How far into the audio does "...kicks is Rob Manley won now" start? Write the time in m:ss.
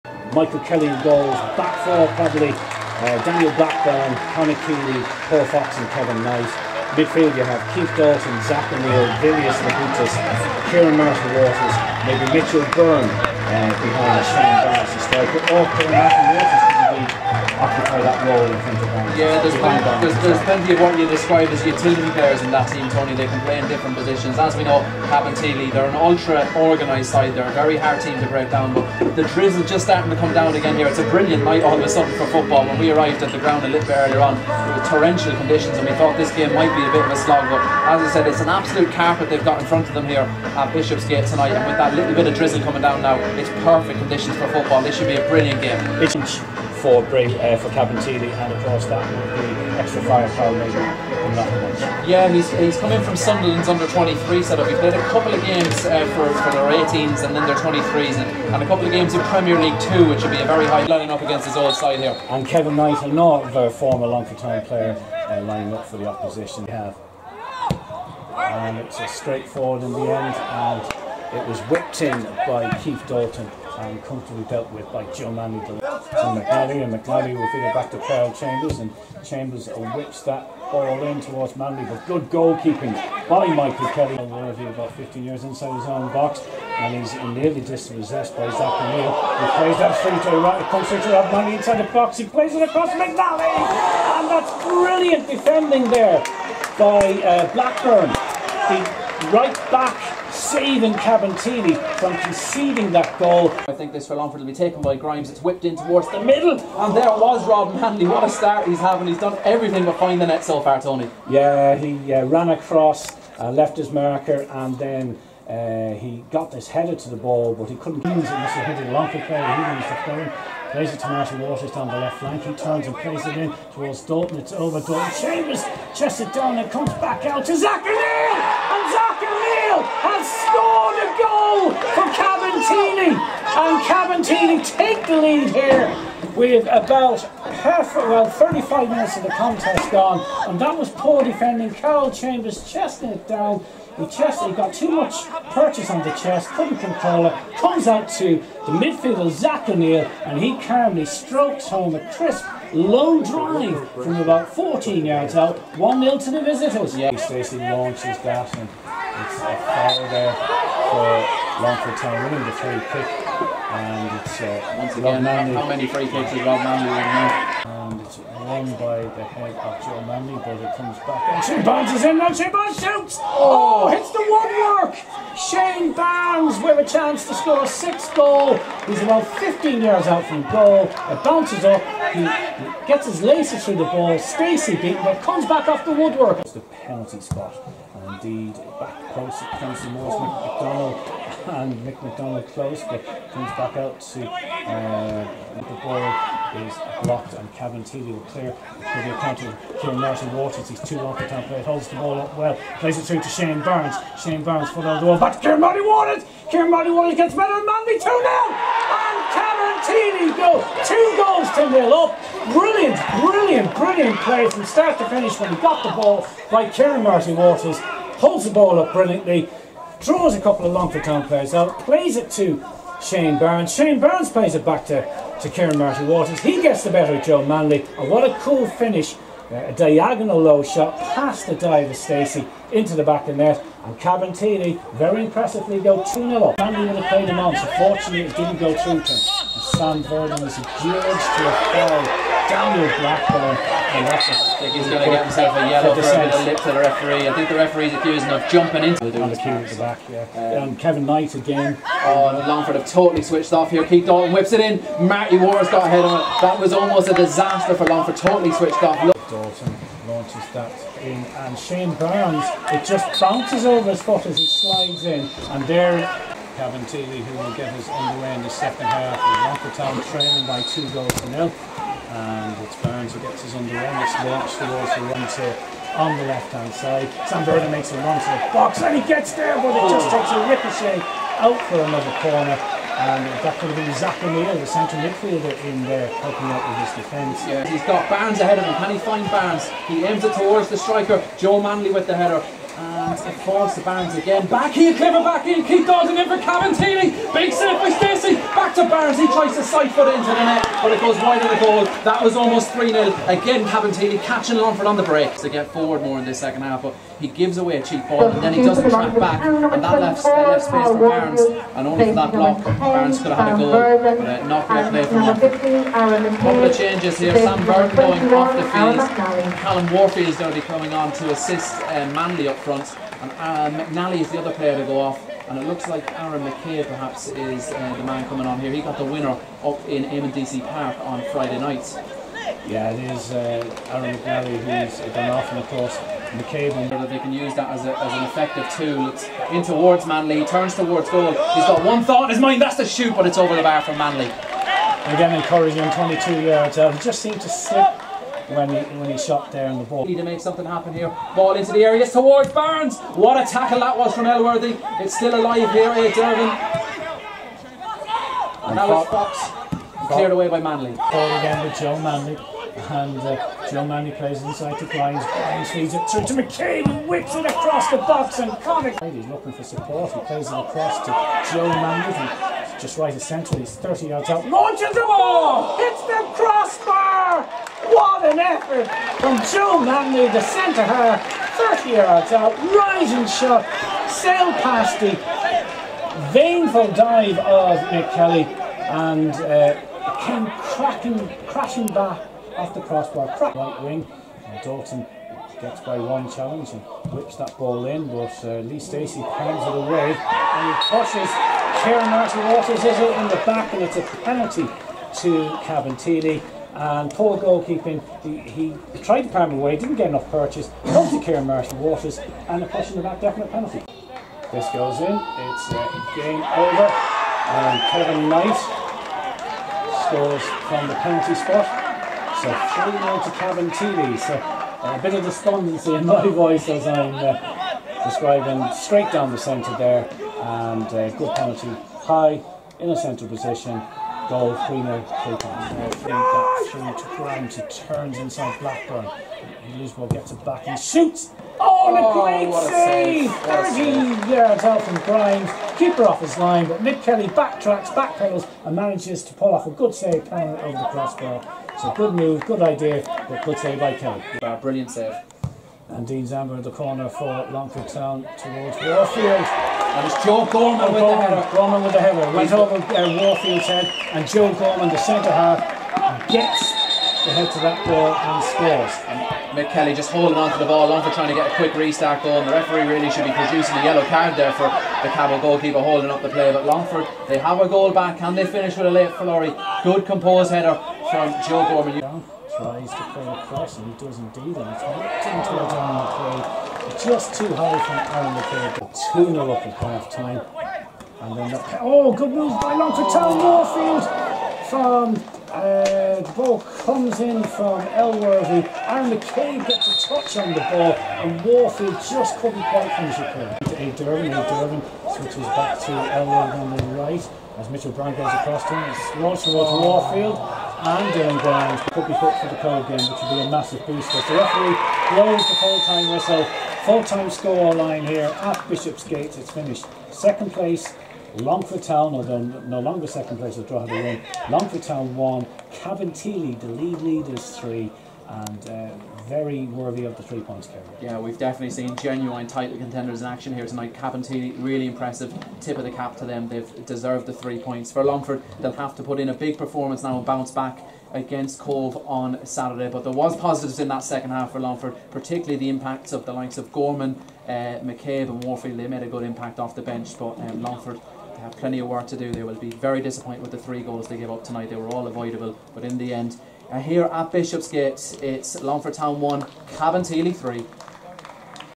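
2:46.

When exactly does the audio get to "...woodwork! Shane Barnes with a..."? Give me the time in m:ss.
2:54.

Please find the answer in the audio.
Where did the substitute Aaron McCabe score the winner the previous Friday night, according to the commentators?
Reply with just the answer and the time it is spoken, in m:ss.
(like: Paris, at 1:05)
DC Park, at 5:30.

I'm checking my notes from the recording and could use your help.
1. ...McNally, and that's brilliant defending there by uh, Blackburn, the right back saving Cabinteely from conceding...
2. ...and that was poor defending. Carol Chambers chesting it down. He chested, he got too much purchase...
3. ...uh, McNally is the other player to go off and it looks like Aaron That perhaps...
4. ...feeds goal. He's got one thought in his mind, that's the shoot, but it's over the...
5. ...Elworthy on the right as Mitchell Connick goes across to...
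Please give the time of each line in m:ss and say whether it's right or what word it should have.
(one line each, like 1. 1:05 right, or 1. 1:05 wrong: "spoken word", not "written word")
1. 1:32 right
2. 2:20 right
3. 5:23 wrong: "McKay", not "That"
4. 5:40 wrong: "towards", not "feeds"
5. 8:25 wrong: "Brown", not "Connick".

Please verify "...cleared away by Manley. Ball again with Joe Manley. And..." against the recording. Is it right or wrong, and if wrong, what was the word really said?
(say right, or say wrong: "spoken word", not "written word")
right.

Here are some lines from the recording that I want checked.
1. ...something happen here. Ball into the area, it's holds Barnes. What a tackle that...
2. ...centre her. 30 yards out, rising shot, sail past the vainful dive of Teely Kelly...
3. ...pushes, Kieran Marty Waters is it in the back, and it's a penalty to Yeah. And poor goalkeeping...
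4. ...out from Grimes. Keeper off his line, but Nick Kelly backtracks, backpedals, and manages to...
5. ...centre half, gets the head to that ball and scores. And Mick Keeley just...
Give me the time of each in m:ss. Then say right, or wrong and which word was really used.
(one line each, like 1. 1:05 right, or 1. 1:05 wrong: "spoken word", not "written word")
1. 5:50 wrong: "towards", not "holds"
2. 6:20 wrong: "Nick", not "Teely"
3. 6:40 wrong: "Cabinteely", not "Yeah"
4. 7:24 right
5. 7:44 wrong: "Kelly", not "Keeley".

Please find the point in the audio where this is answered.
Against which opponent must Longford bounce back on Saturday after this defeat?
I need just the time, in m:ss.
9:01.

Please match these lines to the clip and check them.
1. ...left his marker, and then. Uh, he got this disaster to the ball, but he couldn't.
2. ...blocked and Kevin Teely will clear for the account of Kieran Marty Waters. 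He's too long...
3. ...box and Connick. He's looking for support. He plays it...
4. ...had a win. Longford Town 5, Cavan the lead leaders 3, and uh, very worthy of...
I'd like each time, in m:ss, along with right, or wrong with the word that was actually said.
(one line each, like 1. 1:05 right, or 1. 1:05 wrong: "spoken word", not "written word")
1. 1:53 wrong: "header", not "disaster"
2. 3:17 right
3. 6:07 right
4. 8:43 wrong: "1", not "5".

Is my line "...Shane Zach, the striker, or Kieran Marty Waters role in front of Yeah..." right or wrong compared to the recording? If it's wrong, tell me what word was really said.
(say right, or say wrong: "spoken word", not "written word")
wrong: "Barnes", not "Zach".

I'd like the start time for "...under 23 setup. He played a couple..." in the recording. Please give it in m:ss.
0:53.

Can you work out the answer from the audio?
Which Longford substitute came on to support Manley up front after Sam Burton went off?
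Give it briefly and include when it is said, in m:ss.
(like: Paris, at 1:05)
Callum Warfield, at 5:19.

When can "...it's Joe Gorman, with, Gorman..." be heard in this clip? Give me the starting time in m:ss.
7:40.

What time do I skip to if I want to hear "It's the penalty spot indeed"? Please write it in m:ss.
3:06.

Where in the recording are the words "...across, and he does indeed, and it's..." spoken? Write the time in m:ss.
8:03.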